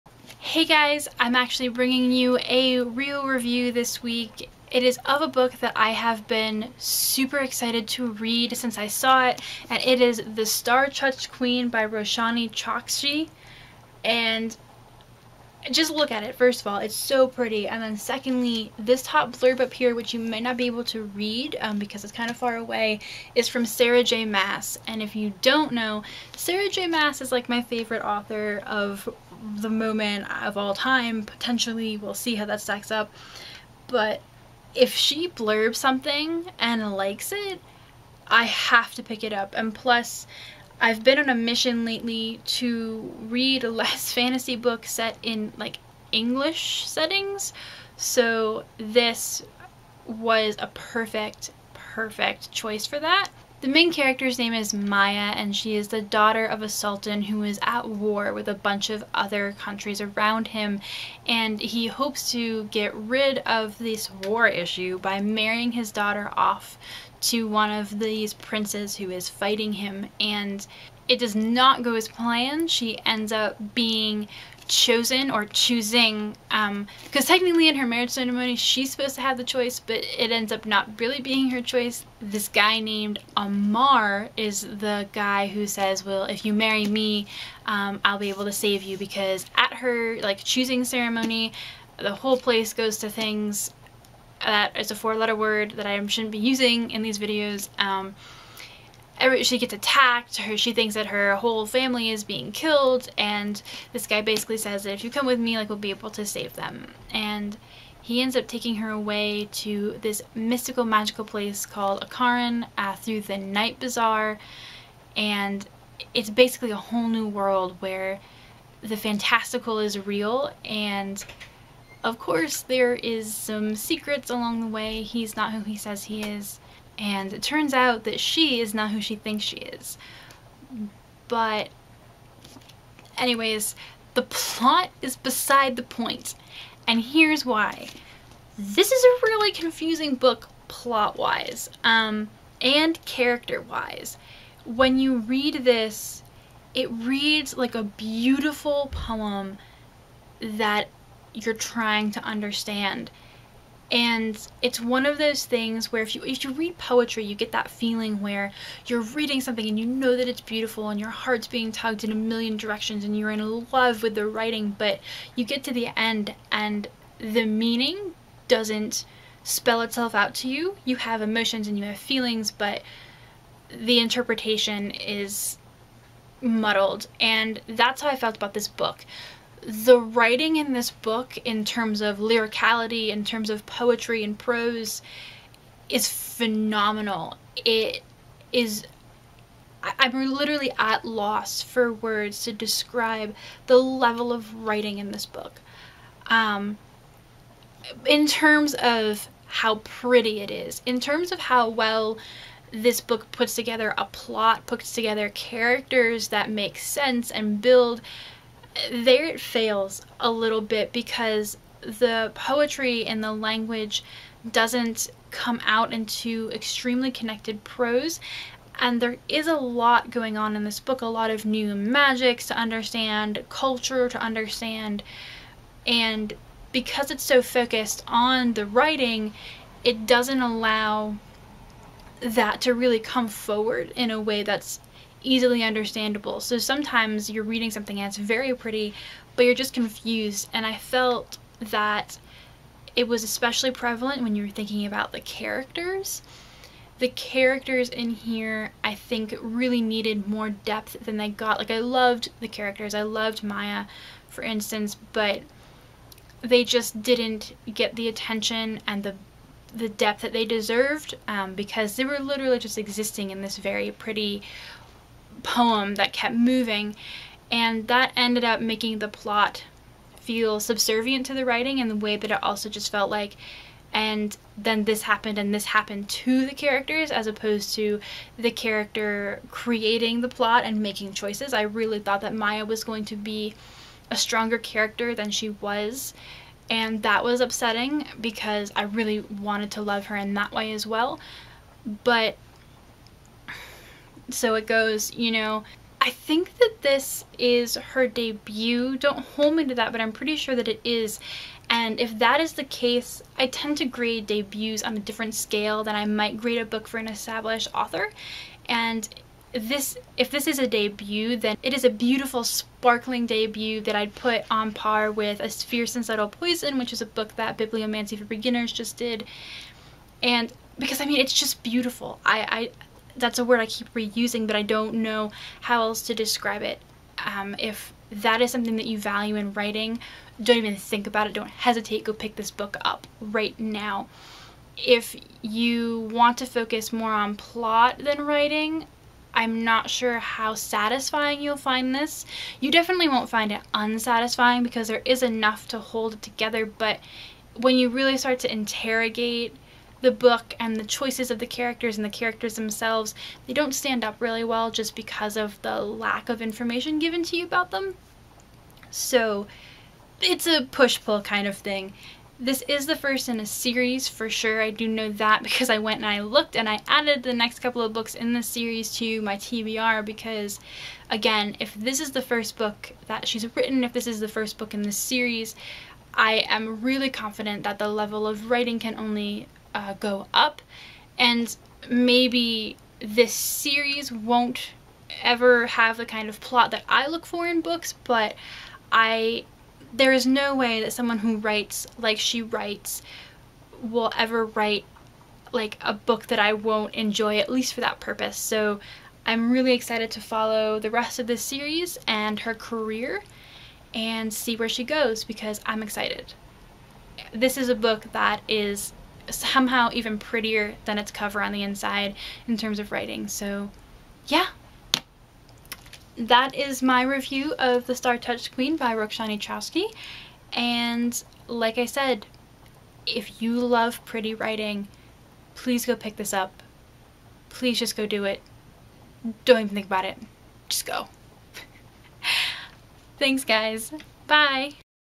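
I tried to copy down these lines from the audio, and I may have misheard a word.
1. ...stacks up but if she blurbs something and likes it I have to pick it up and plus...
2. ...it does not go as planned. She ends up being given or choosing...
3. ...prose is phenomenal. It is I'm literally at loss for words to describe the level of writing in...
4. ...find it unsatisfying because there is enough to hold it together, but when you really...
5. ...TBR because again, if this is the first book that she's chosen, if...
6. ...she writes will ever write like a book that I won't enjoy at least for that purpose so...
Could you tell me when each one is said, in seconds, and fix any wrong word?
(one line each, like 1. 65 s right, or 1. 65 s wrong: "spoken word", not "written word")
1. 32 s right
2. 71 s wrong: "chosen", not "given"
3. 184 s right
4. 343 s right
5. 369 s wrong: "written", not "chosen"
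6. 392 s right.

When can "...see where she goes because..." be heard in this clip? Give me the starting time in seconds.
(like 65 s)
404 s.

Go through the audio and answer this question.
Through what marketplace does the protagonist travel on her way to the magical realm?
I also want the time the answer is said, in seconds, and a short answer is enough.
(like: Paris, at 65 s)
The Night Bazaar, at 113 s.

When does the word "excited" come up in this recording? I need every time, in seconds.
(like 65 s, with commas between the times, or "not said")
7 s, 399 s, 405 s.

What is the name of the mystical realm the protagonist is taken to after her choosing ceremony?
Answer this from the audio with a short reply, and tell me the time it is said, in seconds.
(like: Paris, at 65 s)
Akaran, at 112 s.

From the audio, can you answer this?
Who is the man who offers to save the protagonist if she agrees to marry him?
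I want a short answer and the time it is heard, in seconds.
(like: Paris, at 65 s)
Amar, at 83 s.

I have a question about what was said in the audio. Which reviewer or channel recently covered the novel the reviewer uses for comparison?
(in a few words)
Bibliomancy for Beginners.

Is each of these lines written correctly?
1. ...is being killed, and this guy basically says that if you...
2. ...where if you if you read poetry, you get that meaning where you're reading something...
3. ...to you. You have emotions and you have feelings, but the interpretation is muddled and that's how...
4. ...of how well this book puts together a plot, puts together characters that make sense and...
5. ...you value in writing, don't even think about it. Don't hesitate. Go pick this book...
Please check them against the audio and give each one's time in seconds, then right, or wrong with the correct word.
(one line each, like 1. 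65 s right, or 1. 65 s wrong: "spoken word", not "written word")
1. 102 s right
2. 155 s wrong: "feeling", not "meaning"
3. 170 s right
4. 201 s right
5. 328 s right.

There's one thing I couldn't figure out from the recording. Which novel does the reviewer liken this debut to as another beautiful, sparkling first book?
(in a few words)
A Fierce and Subtle Poison.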